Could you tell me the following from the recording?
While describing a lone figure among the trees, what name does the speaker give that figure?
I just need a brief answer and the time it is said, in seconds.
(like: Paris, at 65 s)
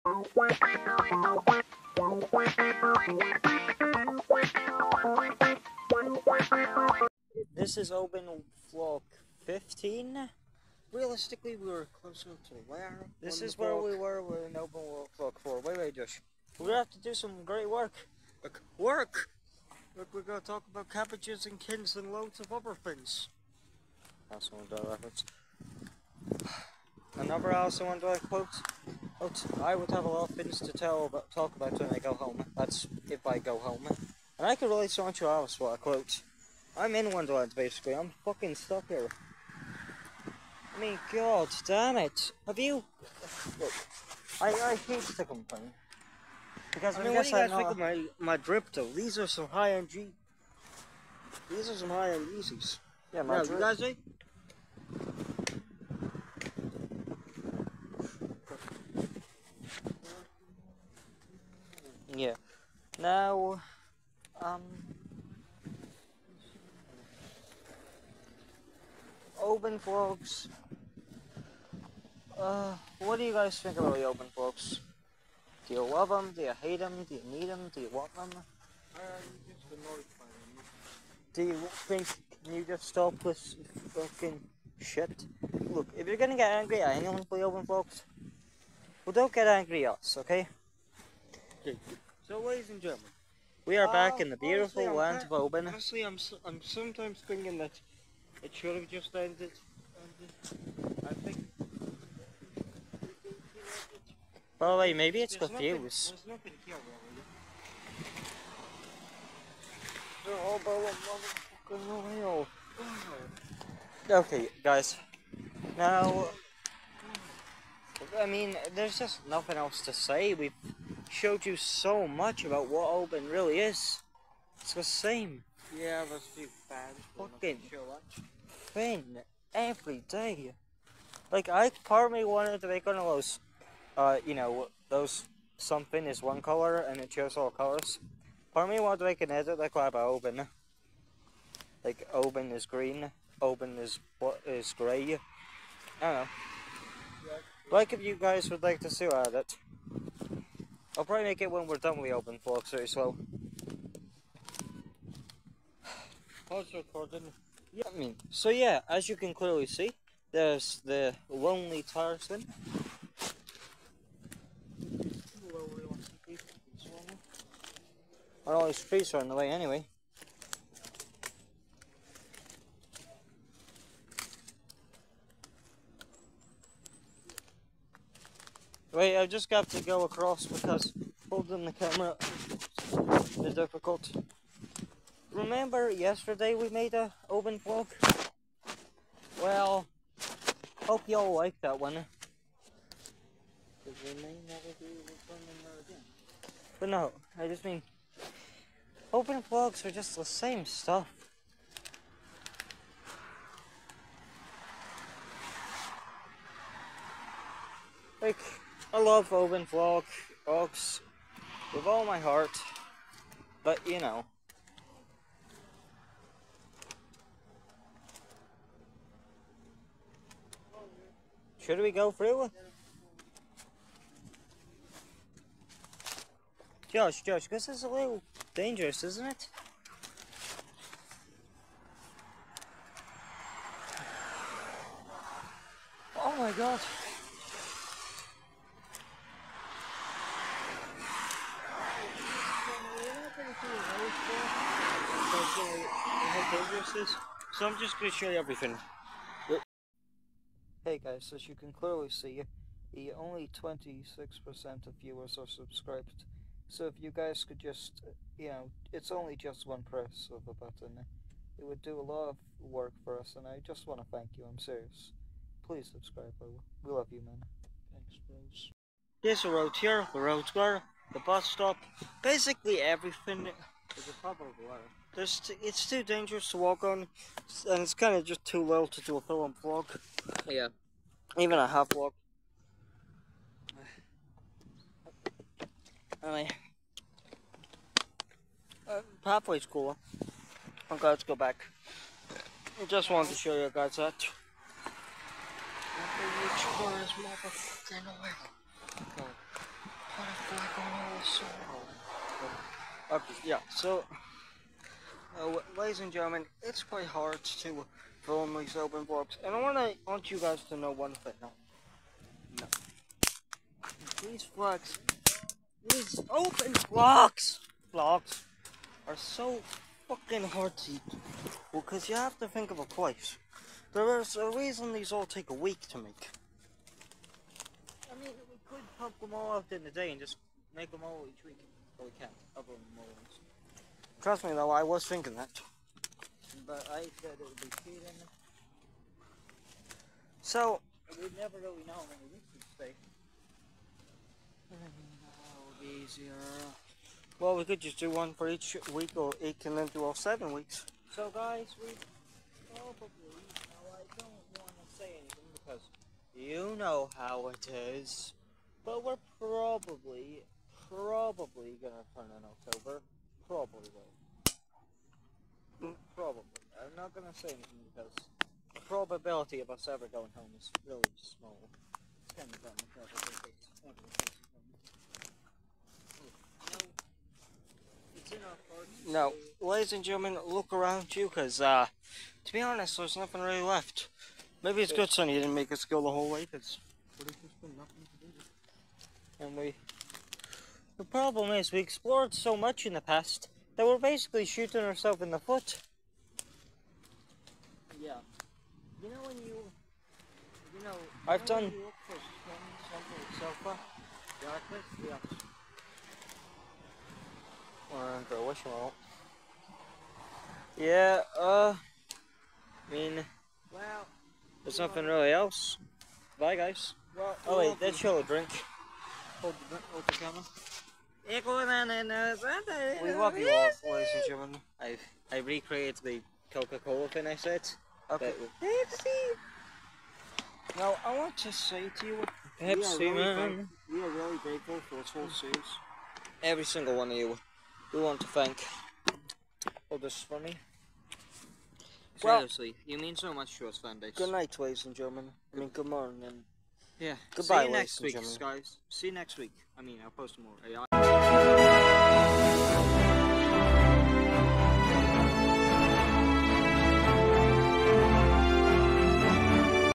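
Tarzan, at 161 s.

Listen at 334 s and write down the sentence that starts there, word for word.
Trust me though, I was thinking that.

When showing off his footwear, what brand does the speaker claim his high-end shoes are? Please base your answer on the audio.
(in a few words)
Yeezys.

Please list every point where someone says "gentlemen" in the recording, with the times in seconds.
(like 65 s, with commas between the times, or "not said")
92 s, 306 s, 380 s, 424 s, 444 s.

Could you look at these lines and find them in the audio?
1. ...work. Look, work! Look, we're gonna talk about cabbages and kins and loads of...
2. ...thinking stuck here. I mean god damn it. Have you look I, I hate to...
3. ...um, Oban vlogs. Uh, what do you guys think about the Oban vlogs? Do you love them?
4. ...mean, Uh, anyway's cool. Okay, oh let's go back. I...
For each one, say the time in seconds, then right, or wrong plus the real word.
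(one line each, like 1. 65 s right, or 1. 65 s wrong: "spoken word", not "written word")
1. 17 s right
2. 38 s wrong: "fucking", not "thinking"
3. 64 s right
4. 286 s wrong: "pathway", not "anyway".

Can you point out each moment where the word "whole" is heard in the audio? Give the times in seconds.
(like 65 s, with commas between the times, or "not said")
386 s, 435 s.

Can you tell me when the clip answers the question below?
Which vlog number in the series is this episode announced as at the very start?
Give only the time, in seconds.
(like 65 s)
7 s.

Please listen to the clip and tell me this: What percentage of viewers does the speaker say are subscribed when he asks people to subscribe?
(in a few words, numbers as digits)
26%.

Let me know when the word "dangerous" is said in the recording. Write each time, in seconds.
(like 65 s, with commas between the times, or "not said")
228 s, 276 s.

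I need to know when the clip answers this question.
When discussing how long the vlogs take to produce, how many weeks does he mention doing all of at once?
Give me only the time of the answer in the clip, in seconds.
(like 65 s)
350 s.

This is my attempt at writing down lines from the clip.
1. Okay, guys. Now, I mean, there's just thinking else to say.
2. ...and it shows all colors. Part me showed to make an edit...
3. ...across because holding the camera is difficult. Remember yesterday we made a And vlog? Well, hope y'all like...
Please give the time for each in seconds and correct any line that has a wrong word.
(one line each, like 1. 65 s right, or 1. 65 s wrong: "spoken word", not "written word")
1. 114 s wrong: "nothing", not "thinking"
2. 136 s wrong: "wanted", not "showed"
3. 180 s wrong: "Oban", not "And".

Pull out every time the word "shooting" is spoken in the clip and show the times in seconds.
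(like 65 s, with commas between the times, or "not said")
394 s.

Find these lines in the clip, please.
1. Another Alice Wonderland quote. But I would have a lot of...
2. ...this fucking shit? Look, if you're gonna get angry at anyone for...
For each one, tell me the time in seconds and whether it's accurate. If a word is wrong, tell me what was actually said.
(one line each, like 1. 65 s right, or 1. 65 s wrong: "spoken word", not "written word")
1. 27 s right
2. 83 s right.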